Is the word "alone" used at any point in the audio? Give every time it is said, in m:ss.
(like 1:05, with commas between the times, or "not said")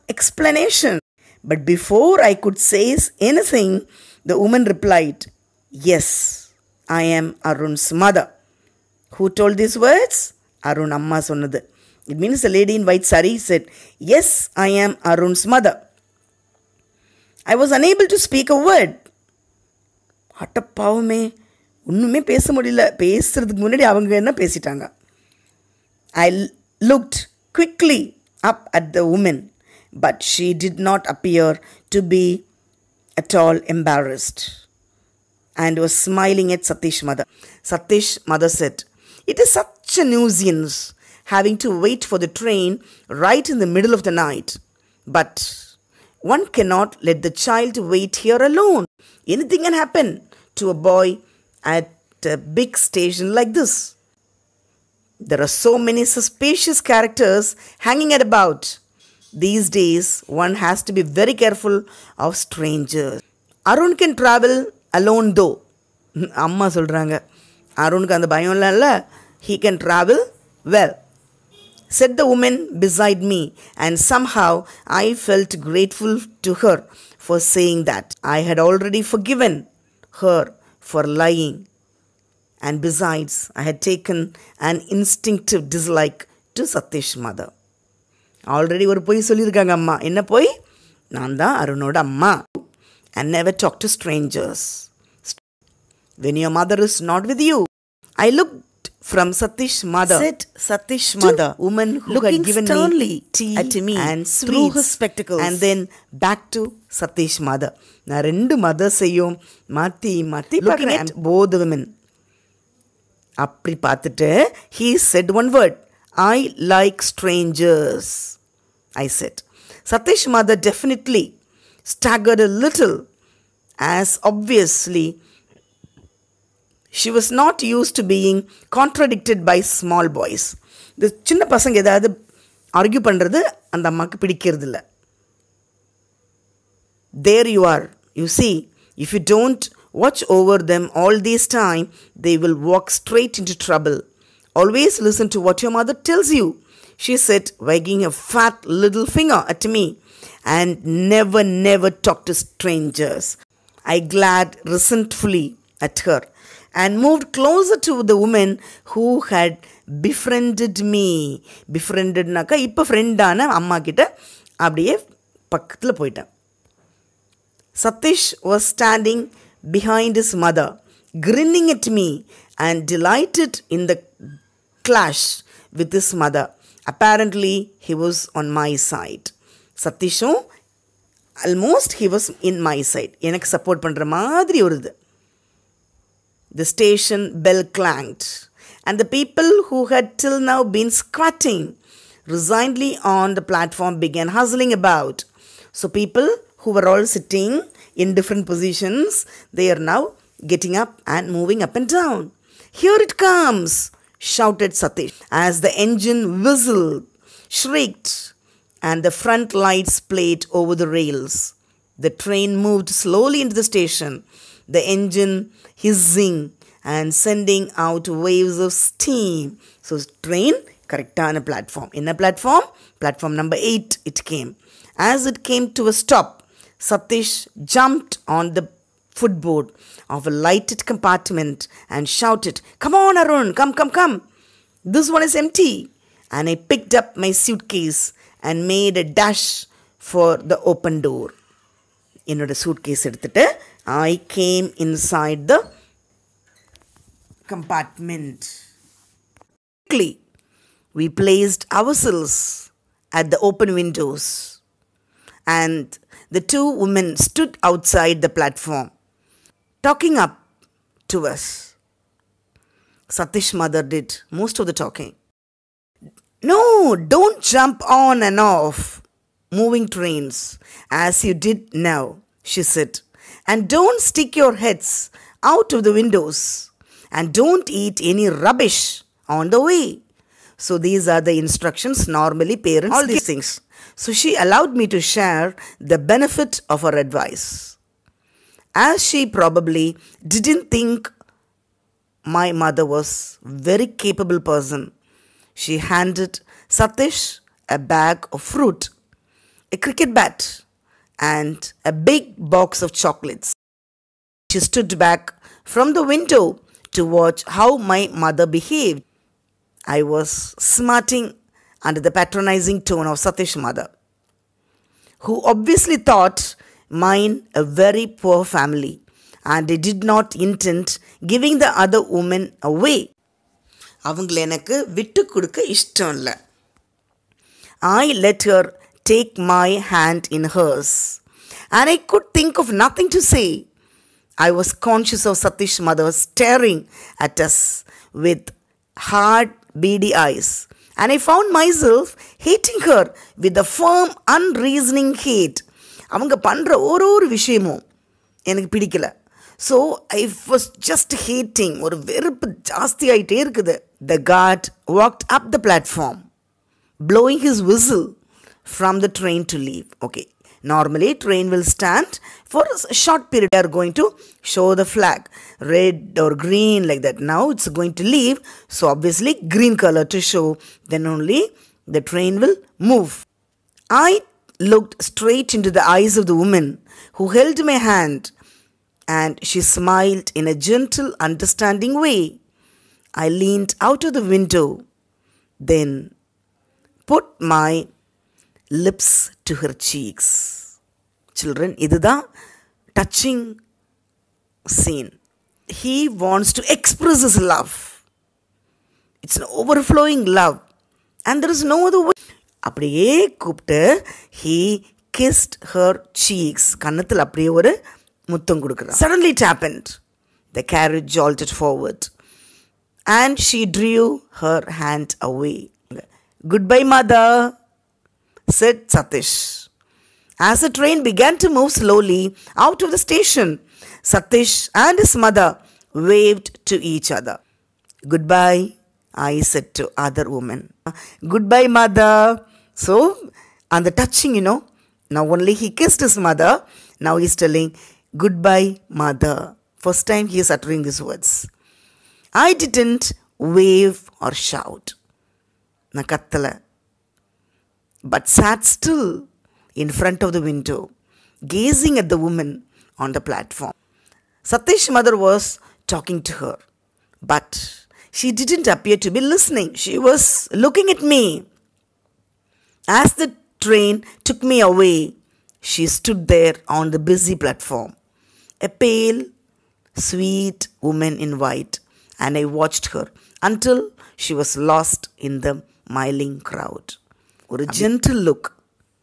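0:48, 1:05.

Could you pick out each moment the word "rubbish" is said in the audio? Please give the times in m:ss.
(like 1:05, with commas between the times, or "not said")
4:38.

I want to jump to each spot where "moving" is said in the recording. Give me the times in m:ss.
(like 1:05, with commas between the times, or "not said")
3:21, 4:29.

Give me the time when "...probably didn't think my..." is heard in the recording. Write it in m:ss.
4:49.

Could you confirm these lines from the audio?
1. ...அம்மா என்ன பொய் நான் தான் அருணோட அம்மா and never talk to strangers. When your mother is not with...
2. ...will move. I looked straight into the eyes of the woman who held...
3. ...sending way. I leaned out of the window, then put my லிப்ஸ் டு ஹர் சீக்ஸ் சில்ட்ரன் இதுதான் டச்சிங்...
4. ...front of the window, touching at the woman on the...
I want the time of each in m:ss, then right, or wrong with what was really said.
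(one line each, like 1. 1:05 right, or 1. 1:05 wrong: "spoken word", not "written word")
1. 1:29 right
2. 6:12 right
3. 6:21 wrong: "understanding", not "sending"
4. 7:29 wrong: "gazing", not "touching".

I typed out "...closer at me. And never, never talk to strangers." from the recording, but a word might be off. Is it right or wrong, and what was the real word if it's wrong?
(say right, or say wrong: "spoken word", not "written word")
wrong: "finger", not "closer".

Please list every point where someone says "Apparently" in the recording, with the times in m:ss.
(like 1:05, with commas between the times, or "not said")
2:56.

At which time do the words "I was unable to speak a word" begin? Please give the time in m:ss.
0:17.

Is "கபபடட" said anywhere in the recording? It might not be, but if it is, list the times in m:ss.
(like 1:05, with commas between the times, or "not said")
6:43.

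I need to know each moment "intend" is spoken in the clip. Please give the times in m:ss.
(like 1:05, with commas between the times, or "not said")
5:20.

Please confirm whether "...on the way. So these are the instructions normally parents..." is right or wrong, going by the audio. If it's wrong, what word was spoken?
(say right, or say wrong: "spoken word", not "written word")
right.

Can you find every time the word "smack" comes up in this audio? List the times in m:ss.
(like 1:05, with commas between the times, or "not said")
not said.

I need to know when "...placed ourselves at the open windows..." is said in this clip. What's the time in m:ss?
4:11.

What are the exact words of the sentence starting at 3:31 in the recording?
The train moved slowly into the station, the engine hissing and sending out waves of steam.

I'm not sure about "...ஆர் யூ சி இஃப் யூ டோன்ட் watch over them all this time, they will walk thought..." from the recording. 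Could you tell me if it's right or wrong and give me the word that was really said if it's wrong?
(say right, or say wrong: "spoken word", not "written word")
wrong: "straight", not "thought".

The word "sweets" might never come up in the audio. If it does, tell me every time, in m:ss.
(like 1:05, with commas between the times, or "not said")
1:44, 7:49.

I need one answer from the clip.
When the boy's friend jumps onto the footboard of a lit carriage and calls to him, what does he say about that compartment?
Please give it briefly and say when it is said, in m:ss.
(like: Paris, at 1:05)
This one is empty, at 3:54.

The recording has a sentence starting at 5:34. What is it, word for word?
I was conscious of Satish's mother staring at us with hard beady eyes.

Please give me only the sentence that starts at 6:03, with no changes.
They are going to show the flag red or green like that.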